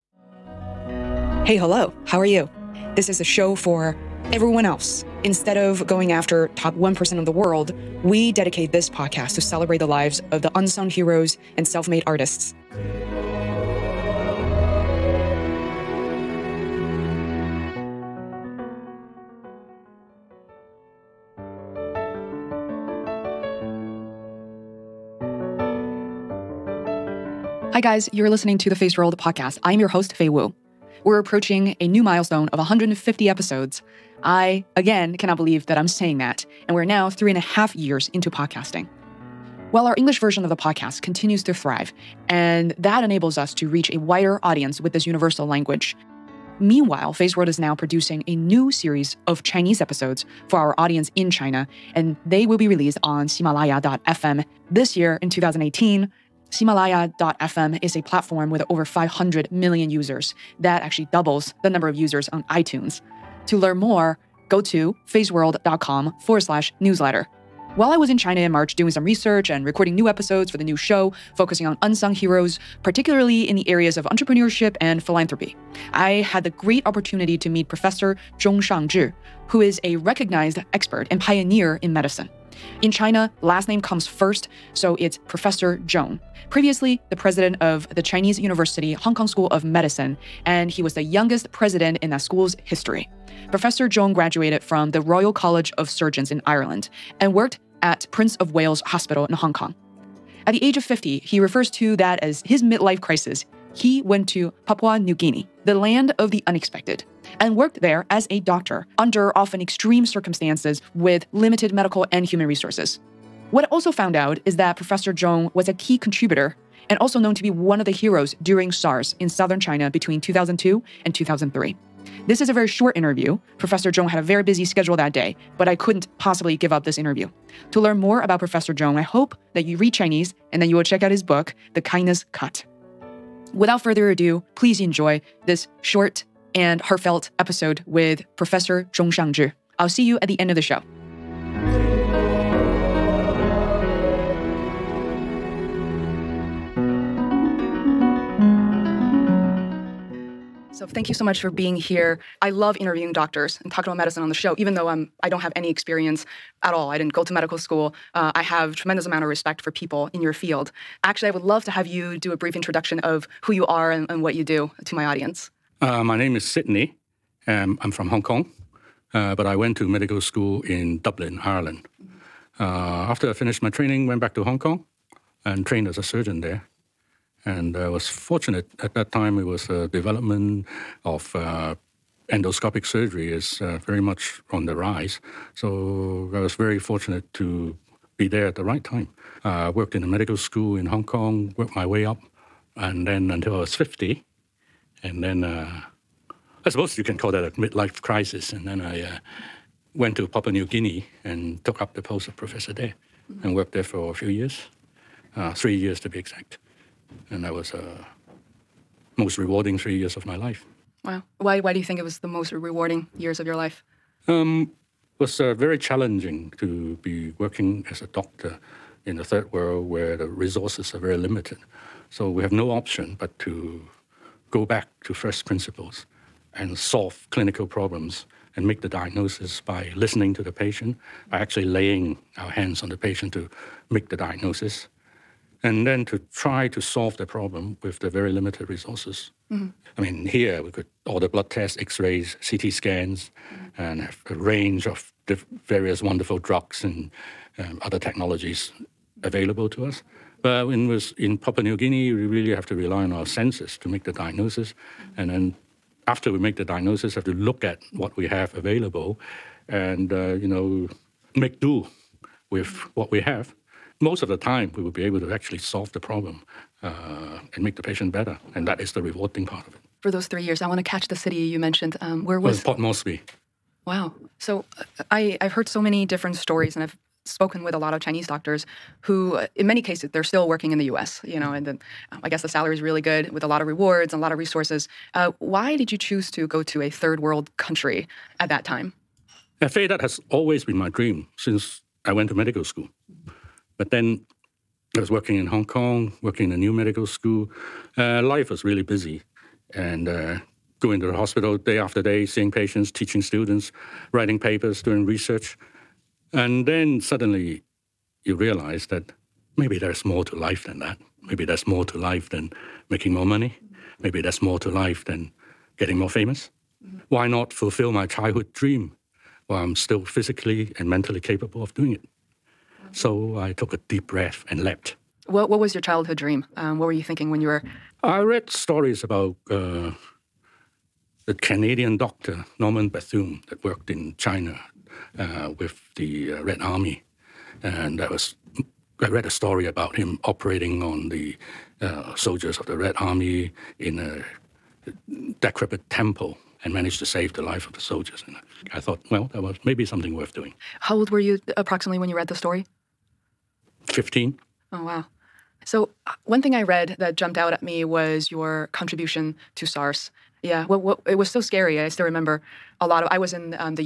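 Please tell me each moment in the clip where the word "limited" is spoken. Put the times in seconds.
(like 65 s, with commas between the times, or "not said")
111 s, 221 s, 238 s.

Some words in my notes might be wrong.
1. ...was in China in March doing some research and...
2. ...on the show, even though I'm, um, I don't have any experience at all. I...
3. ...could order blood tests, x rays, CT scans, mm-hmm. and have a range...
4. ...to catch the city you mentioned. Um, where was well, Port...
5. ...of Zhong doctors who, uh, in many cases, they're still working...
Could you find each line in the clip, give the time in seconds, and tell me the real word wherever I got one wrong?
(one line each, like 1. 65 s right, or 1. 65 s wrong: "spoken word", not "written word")
1. 67 s right
2. 154 s right
3. 240 s right
4. 270 s right
5. 277 s wrong: "Chinese", not "Zhong".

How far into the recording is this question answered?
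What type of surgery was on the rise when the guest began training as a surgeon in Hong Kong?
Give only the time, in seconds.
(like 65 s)
182 s.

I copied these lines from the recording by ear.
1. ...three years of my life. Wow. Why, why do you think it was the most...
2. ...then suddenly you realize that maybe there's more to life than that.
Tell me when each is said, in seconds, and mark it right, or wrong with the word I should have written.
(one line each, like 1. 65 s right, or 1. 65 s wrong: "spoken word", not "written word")
1. 209 s right
2. 306 s right.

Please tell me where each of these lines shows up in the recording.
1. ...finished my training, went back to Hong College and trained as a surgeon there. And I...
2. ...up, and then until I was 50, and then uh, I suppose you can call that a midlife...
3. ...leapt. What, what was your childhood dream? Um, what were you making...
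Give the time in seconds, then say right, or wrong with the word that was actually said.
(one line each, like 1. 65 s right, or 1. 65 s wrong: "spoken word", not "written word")
1. 173 s wrong: "Kong", not "College"
2. 192 s right
3. 324 s wrong: "thinking", not "making".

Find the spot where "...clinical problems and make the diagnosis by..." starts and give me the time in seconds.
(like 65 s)
227 s.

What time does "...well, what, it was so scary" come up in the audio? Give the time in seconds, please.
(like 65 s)
360 s.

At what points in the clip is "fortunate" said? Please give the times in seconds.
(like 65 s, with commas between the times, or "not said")
178 s, 186 s.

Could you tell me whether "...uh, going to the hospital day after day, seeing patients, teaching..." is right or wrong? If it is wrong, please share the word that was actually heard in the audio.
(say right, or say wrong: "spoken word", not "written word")
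right.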